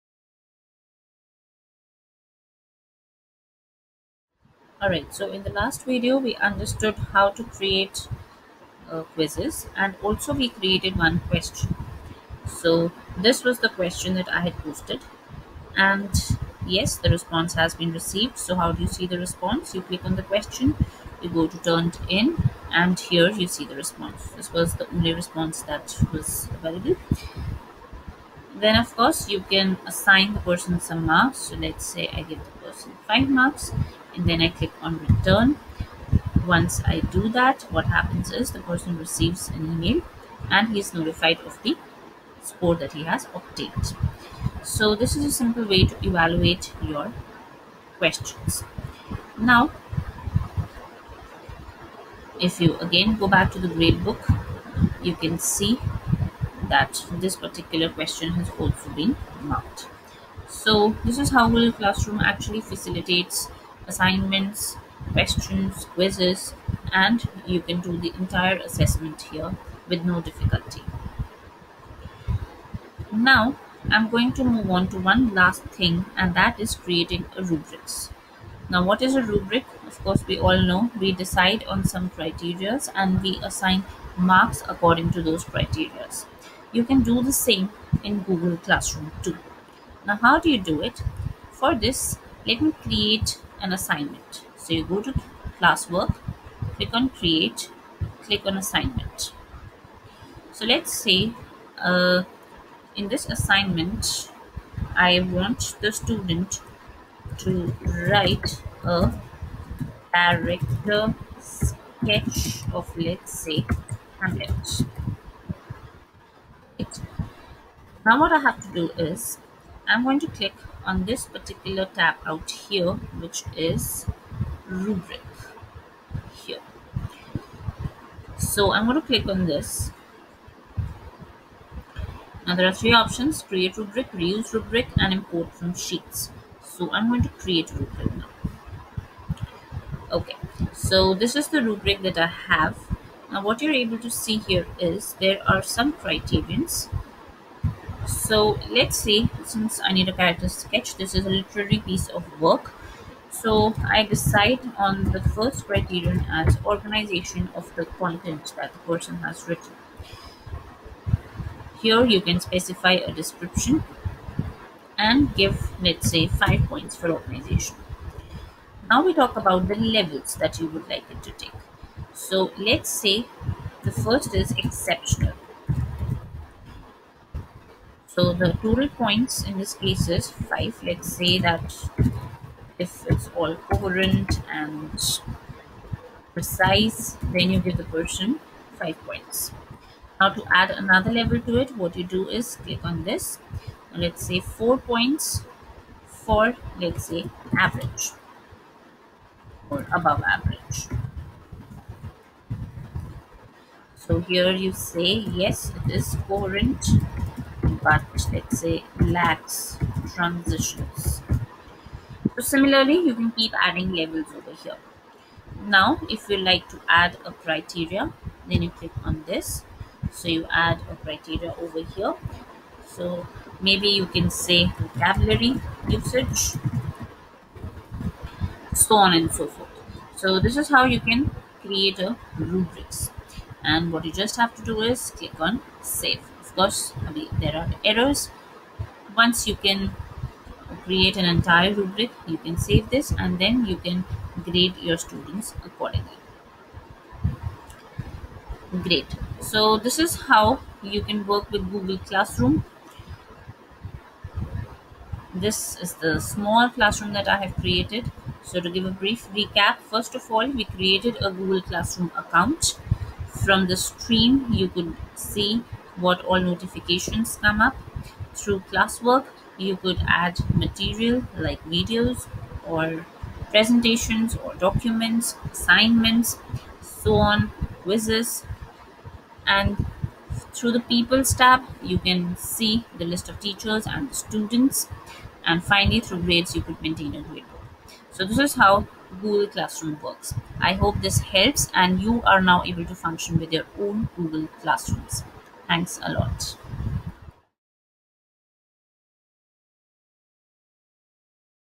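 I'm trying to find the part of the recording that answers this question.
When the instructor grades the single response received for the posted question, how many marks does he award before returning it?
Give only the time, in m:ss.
0:33.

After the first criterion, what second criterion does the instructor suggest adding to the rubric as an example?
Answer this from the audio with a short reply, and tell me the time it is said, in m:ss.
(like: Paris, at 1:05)
Vocabulary usage, at 3:44.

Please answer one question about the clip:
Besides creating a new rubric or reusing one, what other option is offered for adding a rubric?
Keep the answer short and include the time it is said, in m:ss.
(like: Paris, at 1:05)
Import from sheets, at 2:15.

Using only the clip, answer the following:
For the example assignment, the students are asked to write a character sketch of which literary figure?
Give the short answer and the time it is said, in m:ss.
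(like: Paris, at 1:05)
Hamlet, at 1:54.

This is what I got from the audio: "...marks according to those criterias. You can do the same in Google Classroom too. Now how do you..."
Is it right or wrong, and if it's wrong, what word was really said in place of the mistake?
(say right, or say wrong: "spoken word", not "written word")
right.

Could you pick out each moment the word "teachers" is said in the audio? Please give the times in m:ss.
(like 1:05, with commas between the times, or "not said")
4:43.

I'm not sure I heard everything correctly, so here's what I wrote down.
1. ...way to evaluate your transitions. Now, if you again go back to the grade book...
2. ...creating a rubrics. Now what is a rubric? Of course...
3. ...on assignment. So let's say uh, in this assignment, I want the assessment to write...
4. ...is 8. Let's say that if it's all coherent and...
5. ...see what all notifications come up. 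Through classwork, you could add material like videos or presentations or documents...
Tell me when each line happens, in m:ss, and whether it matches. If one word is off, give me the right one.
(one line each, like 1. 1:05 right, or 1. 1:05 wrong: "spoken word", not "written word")
1. 0:45 wrong: "questions", not "transitions"
2. 1:16 right
3. 1:38 wrong: "student", not "assessment"
4. 3:00 wrong: "5", not "8"
5. 4:25 right.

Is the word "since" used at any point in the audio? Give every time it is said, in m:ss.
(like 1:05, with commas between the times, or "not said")
2:29.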